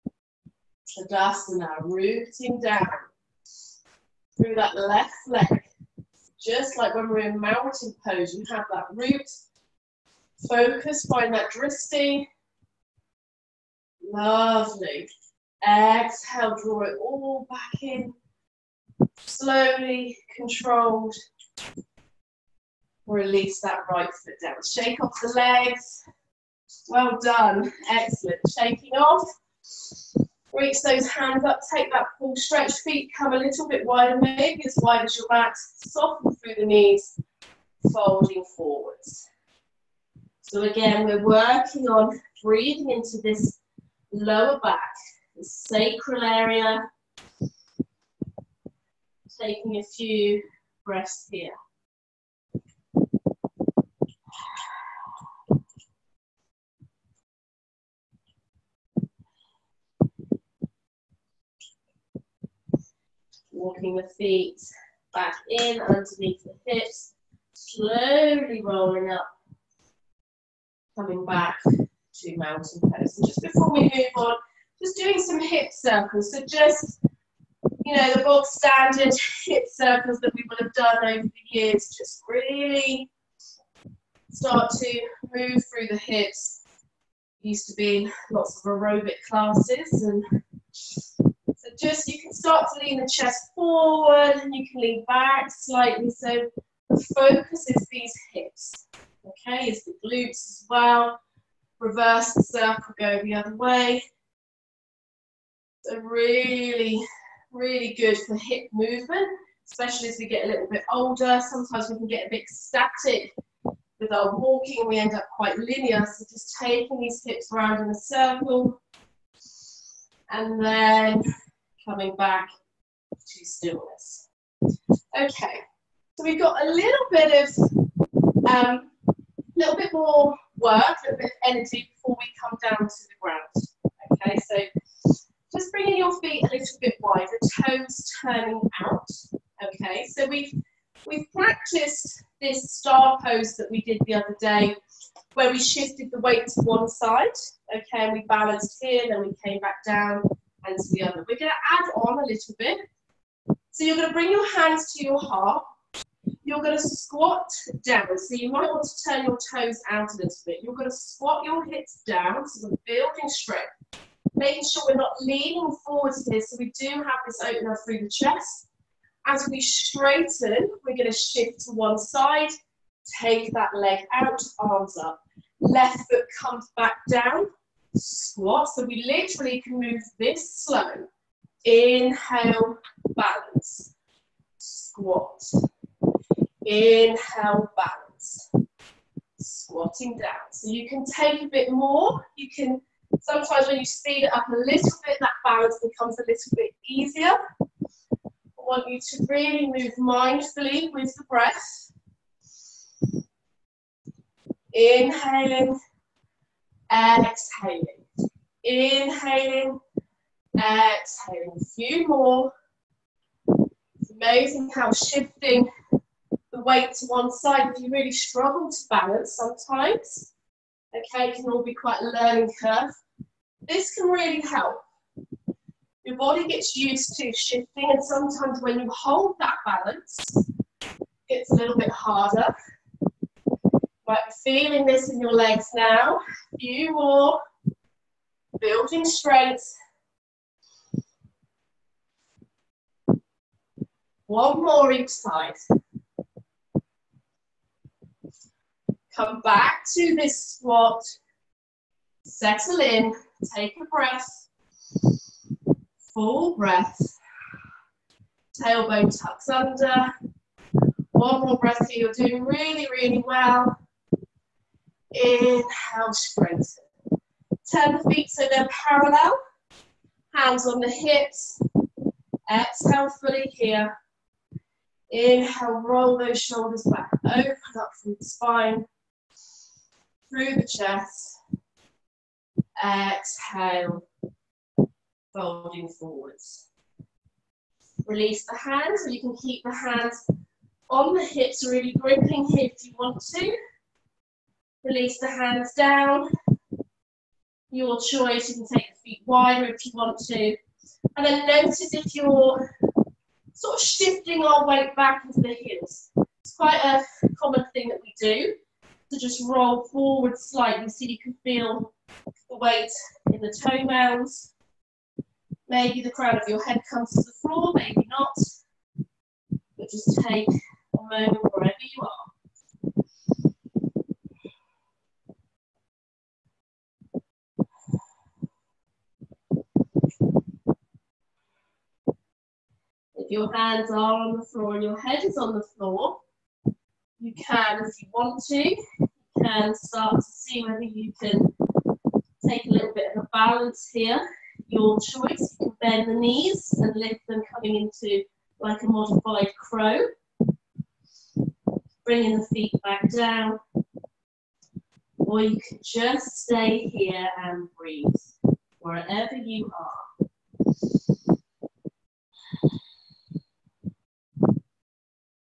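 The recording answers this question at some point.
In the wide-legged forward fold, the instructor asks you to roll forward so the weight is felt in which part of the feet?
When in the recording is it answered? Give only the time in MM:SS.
05:13.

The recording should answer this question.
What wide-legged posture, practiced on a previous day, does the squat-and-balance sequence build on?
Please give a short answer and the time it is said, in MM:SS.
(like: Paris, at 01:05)
Star pose, at 02:22.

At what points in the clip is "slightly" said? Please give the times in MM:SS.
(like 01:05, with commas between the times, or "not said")
01:35, 05:10.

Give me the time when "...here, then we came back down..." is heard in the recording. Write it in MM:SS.
02:28.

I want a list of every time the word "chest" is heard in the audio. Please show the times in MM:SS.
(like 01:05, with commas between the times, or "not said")
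01:33, 02:48, 04:40.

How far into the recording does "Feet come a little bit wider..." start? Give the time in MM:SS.
00:32.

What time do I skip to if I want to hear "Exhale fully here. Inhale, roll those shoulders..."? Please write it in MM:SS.
04:32.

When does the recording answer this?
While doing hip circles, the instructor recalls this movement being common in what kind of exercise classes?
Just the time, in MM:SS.
01:28.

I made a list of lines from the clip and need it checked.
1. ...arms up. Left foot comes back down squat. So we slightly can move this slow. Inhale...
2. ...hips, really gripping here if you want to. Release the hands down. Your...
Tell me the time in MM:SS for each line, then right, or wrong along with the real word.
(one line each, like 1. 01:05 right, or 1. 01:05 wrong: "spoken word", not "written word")
1. 02:54 wrong: "literally", not "slightly"
2. 04:51 right.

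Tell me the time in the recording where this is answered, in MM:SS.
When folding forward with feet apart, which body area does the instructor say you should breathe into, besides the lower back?
00:45.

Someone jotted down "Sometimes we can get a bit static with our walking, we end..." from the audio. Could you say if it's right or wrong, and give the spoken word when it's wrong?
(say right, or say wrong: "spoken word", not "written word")
right.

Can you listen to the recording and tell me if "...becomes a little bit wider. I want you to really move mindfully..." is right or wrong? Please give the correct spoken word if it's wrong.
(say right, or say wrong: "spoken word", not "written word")
wrong: "easier", not "wider".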